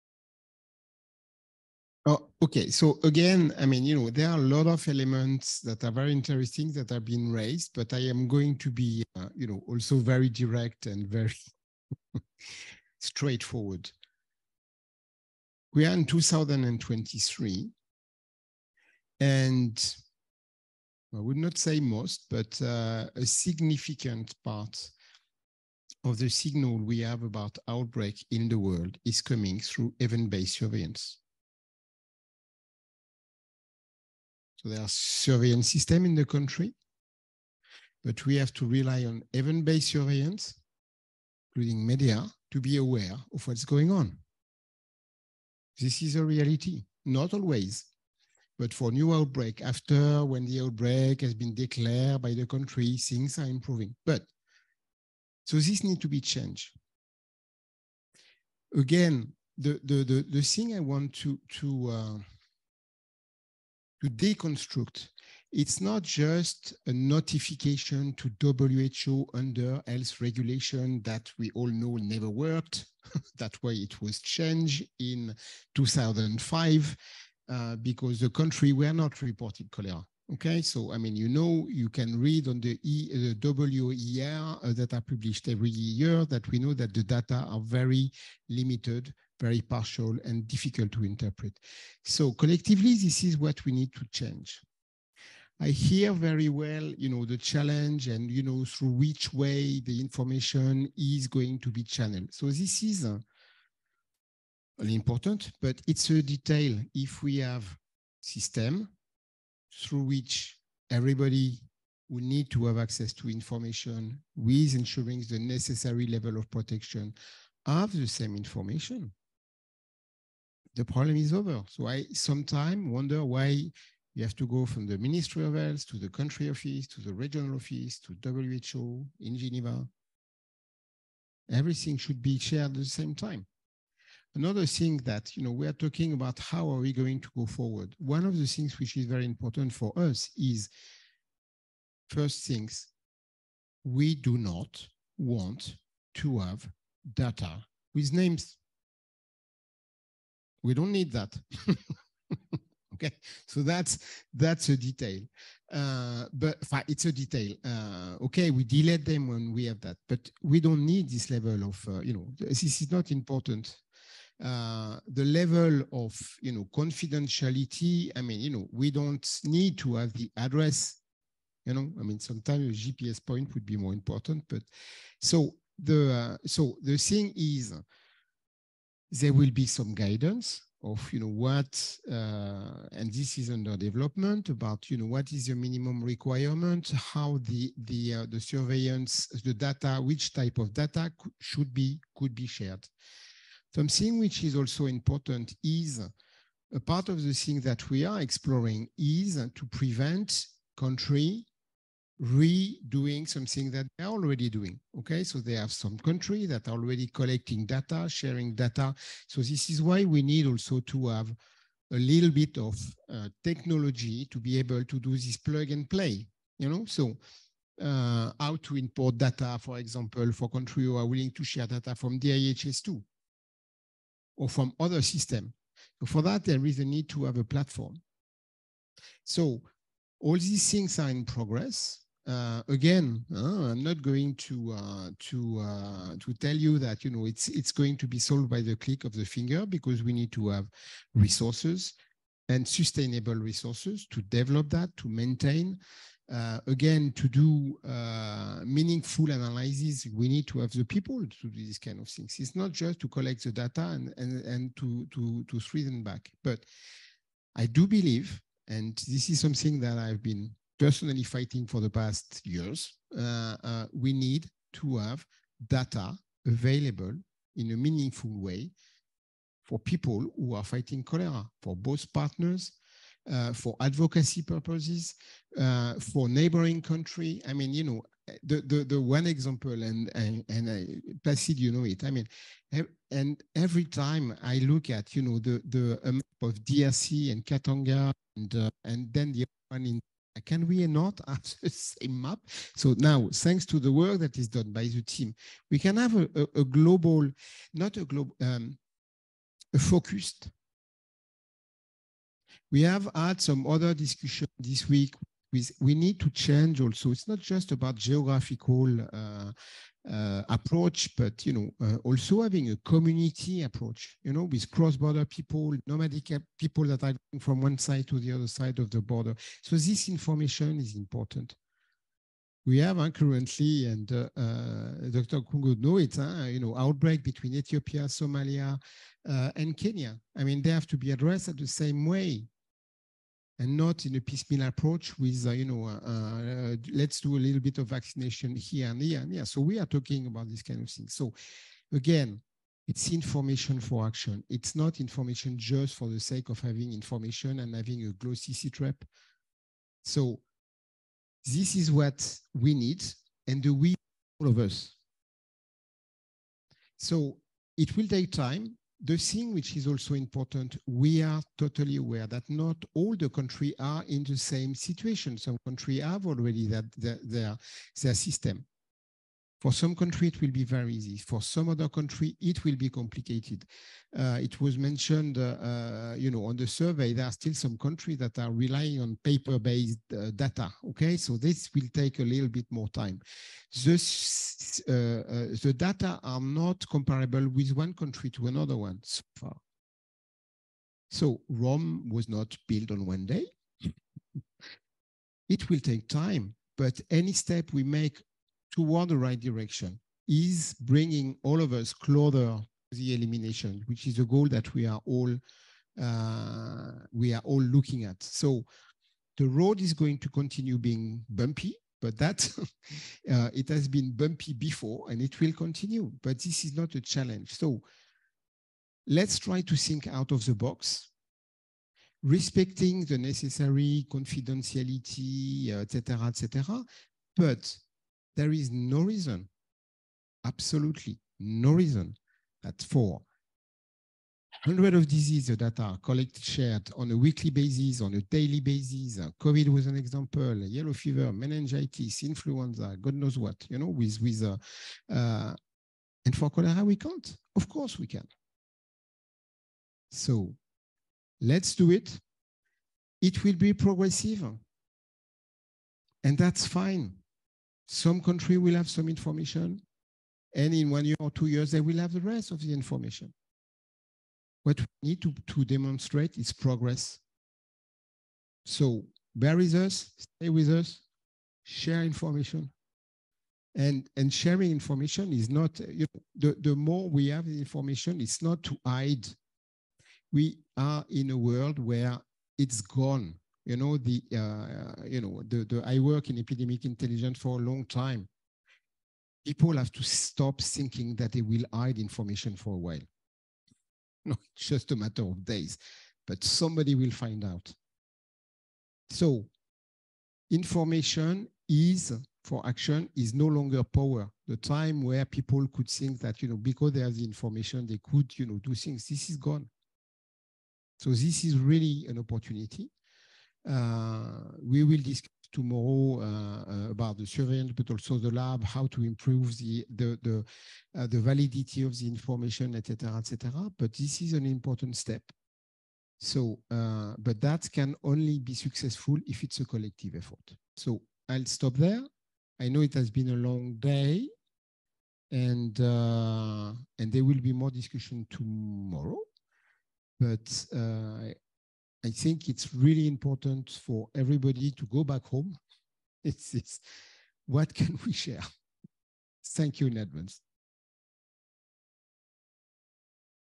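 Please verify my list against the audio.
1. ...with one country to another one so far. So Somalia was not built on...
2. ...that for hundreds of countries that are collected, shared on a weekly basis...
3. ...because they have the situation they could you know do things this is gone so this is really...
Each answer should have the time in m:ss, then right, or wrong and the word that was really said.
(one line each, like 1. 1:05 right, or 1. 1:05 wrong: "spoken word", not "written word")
1. 6:27 wrong: "Rome", not "Somalia"
2. 7:12 wrong: "diseases", not "countries"
3. 8:26 wrong: "information", not "situation".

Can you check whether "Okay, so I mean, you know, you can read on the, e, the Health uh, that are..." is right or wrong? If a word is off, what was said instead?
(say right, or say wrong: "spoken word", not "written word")
wrong: "WER", not "Health".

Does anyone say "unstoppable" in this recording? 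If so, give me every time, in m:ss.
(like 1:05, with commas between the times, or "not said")
not said.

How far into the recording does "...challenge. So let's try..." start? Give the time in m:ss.
6:57.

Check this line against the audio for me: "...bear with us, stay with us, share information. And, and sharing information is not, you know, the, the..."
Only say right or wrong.
right.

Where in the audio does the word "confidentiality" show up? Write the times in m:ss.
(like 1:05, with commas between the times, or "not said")
2:46, 7:04.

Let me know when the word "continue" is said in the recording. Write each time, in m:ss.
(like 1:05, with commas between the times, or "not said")
6:50, 6:55.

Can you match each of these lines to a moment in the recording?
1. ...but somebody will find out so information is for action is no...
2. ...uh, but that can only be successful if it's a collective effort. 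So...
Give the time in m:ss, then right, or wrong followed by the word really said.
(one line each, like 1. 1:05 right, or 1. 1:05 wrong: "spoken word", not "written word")
1. 8:16 right
2. 8:46 right.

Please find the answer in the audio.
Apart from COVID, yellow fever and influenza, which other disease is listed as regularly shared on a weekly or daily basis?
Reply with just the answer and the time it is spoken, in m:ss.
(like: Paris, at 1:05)
Meningitis, at 7:21.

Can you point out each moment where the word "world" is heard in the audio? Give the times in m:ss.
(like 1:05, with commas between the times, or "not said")
0:28, 8:01.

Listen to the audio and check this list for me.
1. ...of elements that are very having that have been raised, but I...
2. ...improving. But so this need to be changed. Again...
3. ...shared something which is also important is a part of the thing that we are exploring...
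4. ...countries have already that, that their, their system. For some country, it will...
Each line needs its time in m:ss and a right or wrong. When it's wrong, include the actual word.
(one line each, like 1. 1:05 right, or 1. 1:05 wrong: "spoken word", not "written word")
1. 0:04 wrong: "interesting", not "having"
2. 0:53 right
3. 3:12 right
4. 6:05 right.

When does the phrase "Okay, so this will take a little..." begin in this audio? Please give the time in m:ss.
6:20.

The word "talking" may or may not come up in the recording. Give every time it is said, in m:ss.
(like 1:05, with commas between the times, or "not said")
2:15, 5:39.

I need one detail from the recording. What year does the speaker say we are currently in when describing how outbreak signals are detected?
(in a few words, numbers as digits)
2023.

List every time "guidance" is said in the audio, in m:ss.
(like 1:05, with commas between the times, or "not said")
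2:59.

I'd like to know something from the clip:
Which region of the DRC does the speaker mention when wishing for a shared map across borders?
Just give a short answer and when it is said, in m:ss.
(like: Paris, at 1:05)
Katanga, at 4:47.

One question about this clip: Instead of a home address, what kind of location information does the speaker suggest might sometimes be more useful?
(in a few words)
A GPS point.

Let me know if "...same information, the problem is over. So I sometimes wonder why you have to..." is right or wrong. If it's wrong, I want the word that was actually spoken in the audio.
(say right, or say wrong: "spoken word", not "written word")
right.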